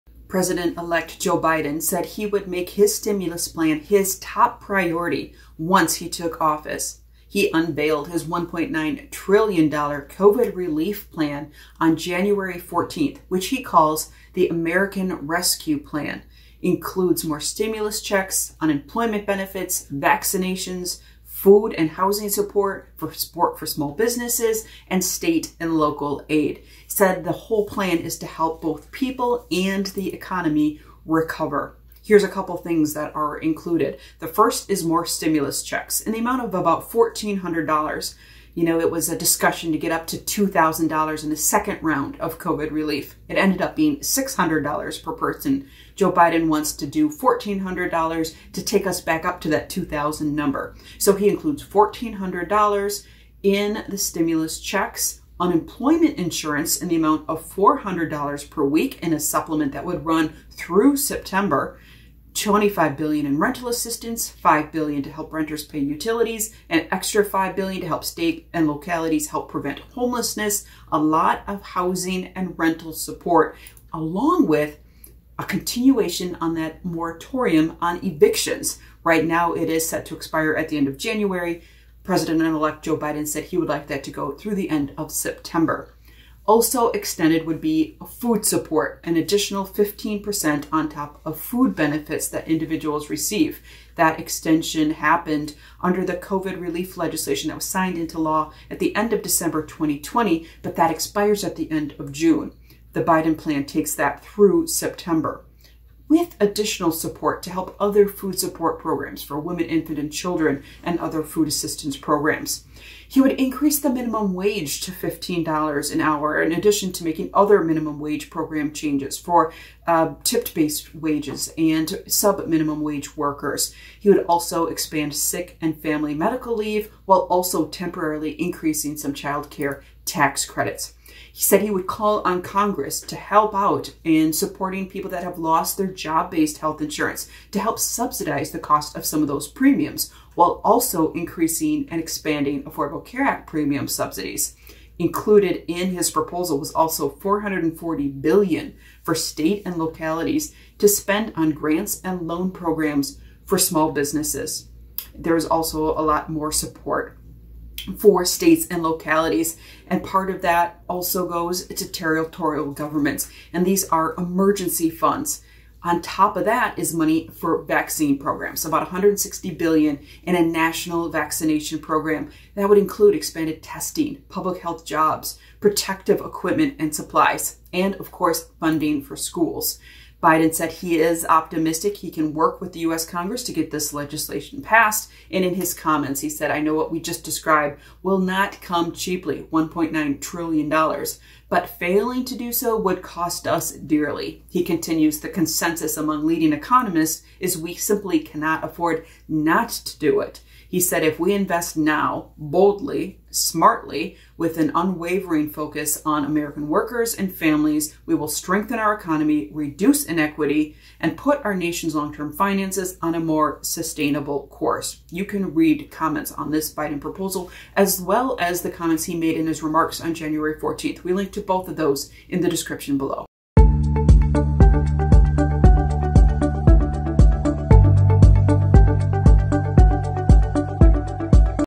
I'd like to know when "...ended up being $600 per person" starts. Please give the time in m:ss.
0:43.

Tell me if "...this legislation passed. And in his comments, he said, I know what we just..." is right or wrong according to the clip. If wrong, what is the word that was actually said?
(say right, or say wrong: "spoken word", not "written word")
right.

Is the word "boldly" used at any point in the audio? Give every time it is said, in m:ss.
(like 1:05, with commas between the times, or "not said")
3:22.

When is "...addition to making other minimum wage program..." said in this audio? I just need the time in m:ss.
1:56.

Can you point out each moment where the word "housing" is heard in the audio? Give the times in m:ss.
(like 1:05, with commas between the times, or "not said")
0:21, 1:11.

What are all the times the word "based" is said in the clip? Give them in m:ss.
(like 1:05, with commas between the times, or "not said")
2:00, 2:16.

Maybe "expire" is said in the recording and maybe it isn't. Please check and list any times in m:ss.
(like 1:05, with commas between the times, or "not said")
1:20, 1:40.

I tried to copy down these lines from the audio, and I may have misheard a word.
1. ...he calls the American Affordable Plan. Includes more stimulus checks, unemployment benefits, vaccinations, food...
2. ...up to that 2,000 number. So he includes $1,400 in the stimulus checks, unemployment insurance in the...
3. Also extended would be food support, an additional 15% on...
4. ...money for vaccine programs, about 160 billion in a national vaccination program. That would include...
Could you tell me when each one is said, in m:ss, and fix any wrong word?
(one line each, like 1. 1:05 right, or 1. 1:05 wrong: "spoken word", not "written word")
1. 0:13 wrong: "Rescue", not "Affordable"
2. 0:49 right
3. 1:26 right
4. 2:46 right.